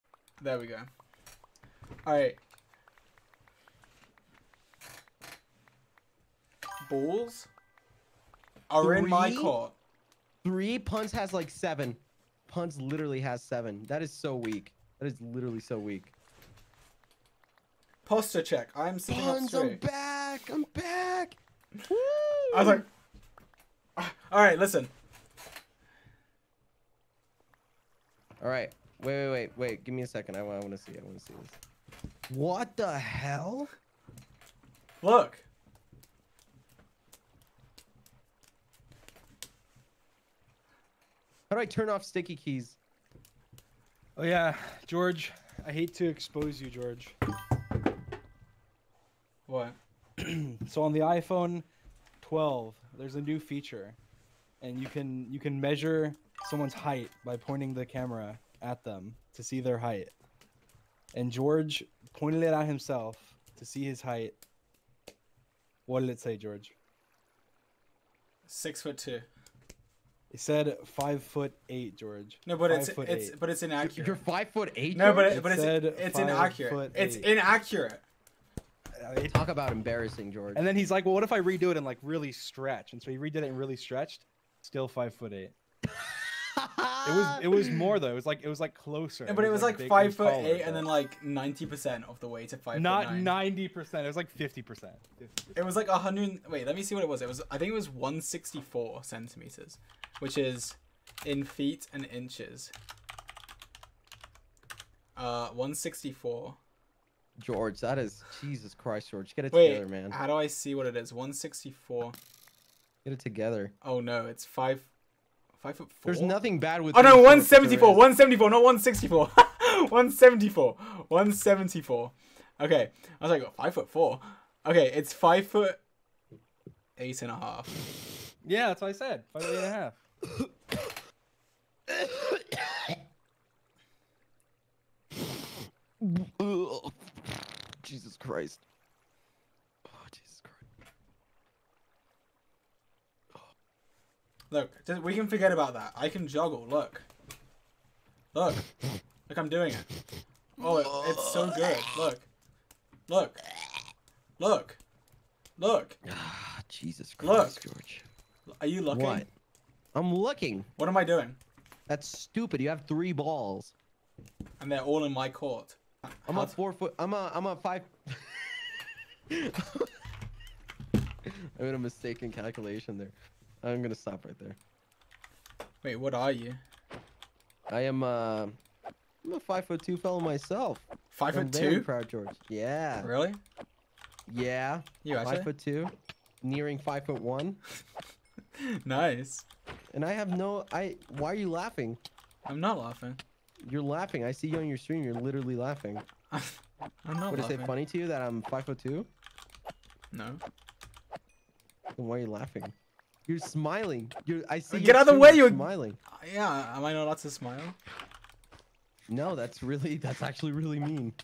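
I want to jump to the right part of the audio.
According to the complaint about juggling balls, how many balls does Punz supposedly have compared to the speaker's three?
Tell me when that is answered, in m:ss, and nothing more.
0:12.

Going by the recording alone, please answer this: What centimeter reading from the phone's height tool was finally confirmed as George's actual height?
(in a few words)
174.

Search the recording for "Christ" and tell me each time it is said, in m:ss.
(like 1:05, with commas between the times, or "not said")
1:48, 2:18, 2:37.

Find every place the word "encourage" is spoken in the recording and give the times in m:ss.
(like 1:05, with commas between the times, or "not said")
not said.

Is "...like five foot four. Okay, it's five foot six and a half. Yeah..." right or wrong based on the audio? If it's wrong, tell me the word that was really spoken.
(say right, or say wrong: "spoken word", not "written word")
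wrong: "eight", not "six".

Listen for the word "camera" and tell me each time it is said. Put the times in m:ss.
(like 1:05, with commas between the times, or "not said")
0:57.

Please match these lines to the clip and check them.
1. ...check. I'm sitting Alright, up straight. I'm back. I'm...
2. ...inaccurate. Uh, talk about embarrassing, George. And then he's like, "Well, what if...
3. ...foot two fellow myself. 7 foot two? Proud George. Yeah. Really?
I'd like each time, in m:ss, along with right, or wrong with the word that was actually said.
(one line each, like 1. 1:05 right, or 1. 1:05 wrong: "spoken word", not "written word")
1. 0:18 wrong: "Punz", not "Alright"
2. 1:17 right
3. 2:59 wrong: "5", not "7".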